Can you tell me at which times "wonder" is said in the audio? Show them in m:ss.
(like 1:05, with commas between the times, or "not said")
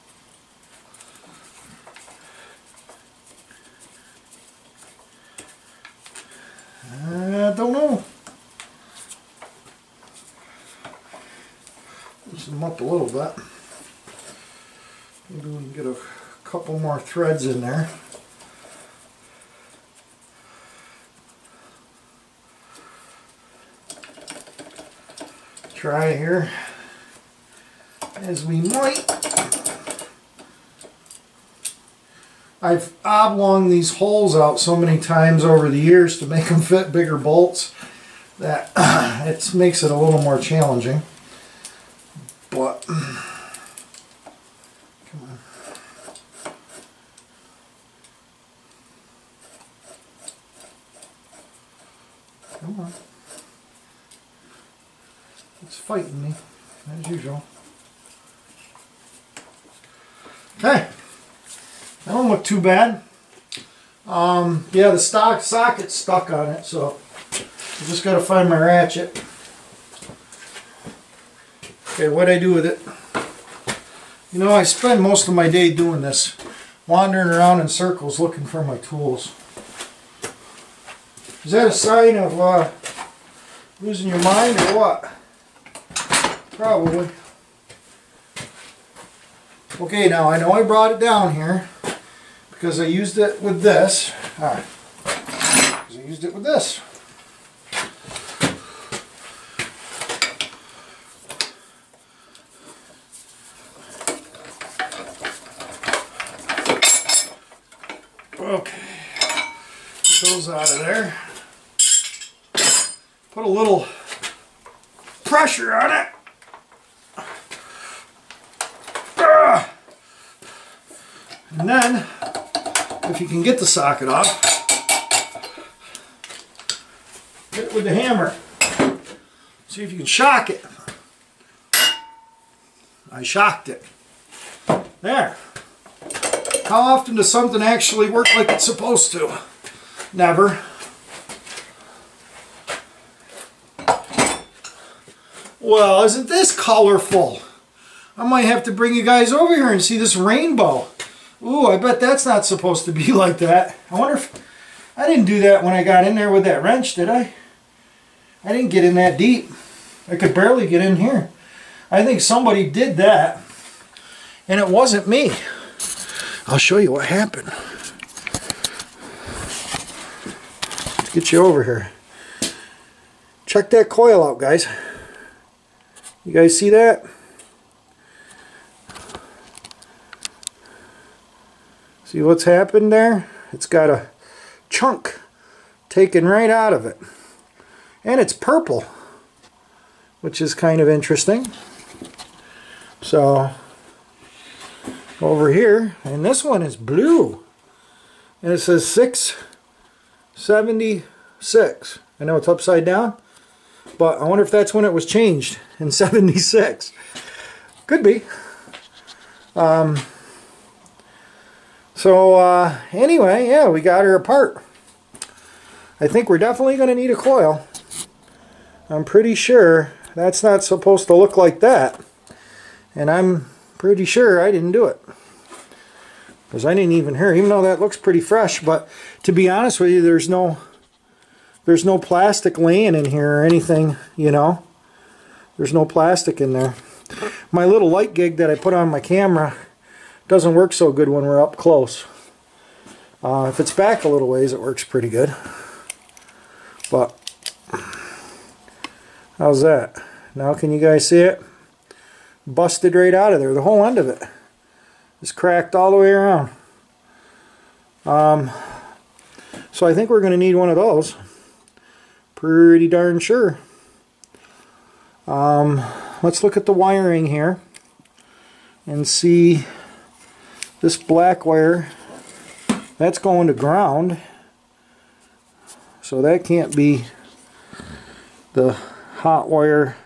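2:33, 3:24.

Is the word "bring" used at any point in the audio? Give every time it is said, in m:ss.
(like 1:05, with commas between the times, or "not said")
2:28.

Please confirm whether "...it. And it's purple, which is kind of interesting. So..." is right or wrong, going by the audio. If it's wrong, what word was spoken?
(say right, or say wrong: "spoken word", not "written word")
right.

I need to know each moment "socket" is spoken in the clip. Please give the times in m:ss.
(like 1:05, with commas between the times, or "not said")
1:05, 2:03.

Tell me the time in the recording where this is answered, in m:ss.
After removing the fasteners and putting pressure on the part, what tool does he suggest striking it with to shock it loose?
2:07.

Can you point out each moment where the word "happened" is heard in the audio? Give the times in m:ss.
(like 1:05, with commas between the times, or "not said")
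2:47, 3:02.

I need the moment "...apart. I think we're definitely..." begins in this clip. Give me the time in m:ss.
3:34.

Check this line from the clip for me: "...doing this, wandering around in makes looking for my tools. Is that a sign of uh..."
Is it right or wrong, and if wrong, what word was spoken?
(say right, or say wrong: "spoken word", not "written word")
wrong: "circles", not "makes".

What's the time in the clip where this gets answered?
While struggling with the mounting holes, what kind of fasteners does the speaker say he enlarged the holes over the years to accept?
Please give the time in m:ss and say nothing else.
0:36.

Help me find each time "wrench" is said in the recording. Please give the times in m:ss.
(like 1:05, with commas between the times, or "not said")
2:36.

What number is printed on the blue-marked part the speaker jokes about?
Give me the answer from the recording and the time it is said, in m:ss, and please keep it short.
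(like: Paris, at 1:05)
676, at 3:18.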